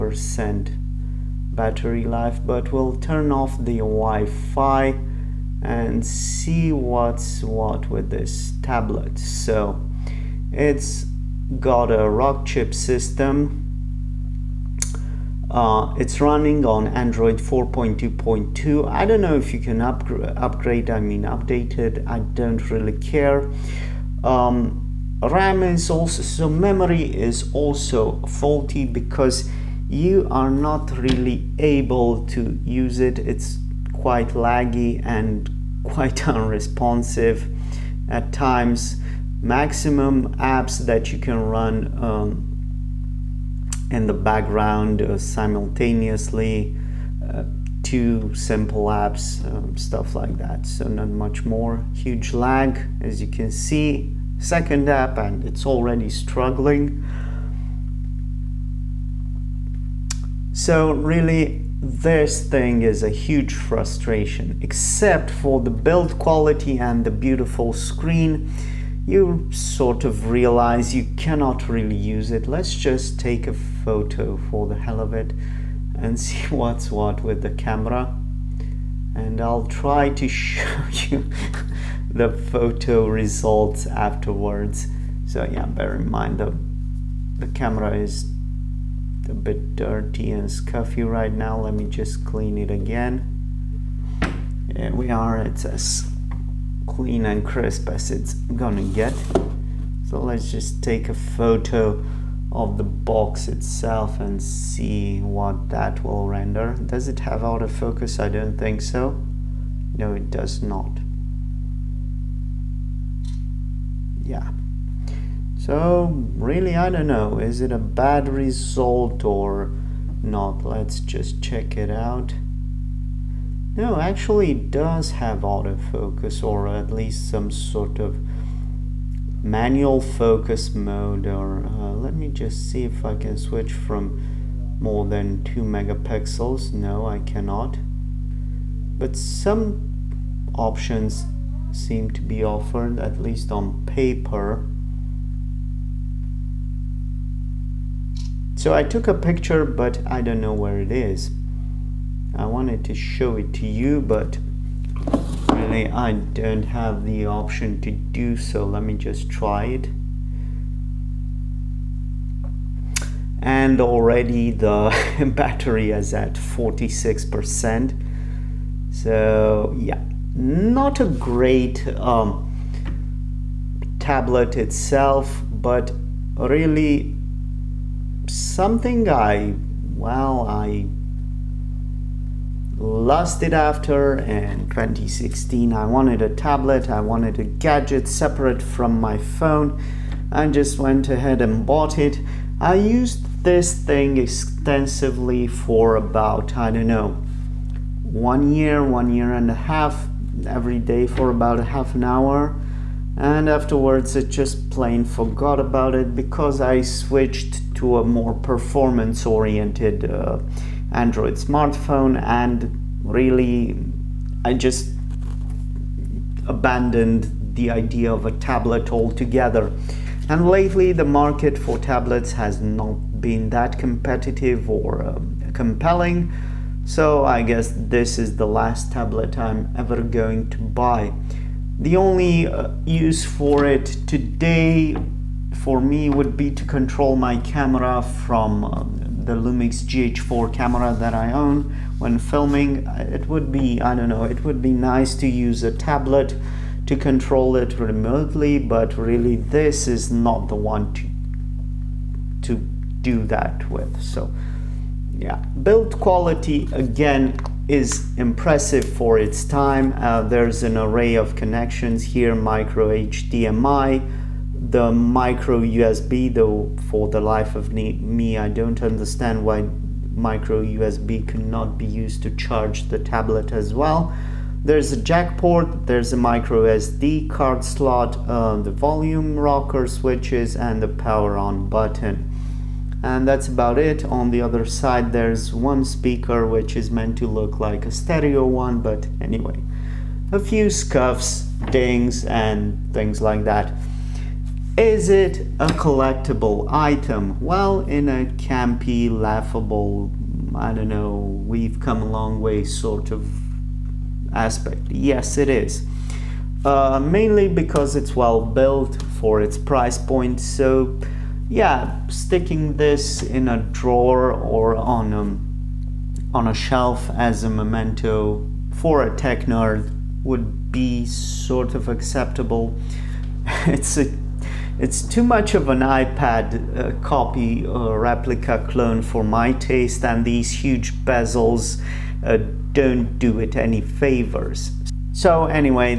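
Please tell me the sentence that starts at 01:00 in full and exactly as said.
So really this thing is a huge frustration, except for the build quality and the beautiful screen.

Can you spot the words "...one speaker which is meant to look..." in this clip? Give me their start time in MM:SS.
04:45.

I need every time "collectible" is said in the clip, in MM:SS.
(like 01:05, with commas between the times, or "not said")
04:55.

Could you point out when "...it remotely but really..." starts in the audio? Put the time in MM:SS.
04:07.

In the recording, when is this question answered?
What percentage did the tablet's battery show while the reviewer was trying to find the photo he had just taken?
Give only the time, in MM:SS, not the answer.
02:46.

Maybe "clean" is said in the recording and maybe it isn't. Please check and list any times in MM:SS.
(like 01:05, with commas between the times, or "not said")
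01:32, 01:36.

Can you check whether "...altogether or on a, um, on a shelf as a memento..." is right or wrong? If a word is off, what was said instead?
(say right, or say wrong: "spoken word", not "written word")
wrong: "drawer", not "altogether".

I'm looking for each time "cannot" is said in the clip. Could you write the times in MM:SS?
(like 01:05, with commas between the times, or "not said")
01:11, 02:17, 04:31.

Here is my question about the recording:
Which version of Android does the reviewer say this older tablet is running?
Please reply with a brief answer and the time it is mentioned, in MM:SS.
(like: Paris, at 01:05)
4.2.2, at 00:16.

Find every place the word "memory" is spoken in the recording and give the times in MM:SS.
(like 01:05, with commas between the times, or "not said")
00:26.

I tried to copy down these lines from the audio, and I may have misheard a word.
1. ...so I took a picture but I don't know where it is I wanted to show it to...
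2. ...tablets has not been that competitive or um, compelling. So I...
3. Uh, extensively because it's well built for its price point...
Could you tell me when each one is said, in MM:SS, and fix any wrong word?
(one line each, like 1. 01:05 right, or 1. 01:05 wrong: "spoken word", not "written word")
1. 02:28 right
2. 03:41 right
3. 05:06 wrong: "mainly", not "extensively".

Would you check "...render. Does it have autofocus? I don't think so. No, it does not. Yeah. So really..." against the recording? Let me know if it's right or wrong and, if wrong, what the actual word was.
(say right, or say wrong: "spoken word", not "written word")
right.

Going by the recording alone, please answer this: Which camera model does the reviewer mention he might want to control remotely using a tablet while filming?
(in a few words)
Lumix GH4.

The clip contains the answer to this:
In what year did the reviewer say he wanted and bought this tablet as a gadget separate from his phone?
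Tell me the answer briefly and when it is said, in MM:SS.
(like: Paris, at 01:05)
2016, at 03:04.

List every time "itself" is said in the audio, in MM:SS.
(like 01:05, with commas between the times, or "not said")
01:43, 02:54.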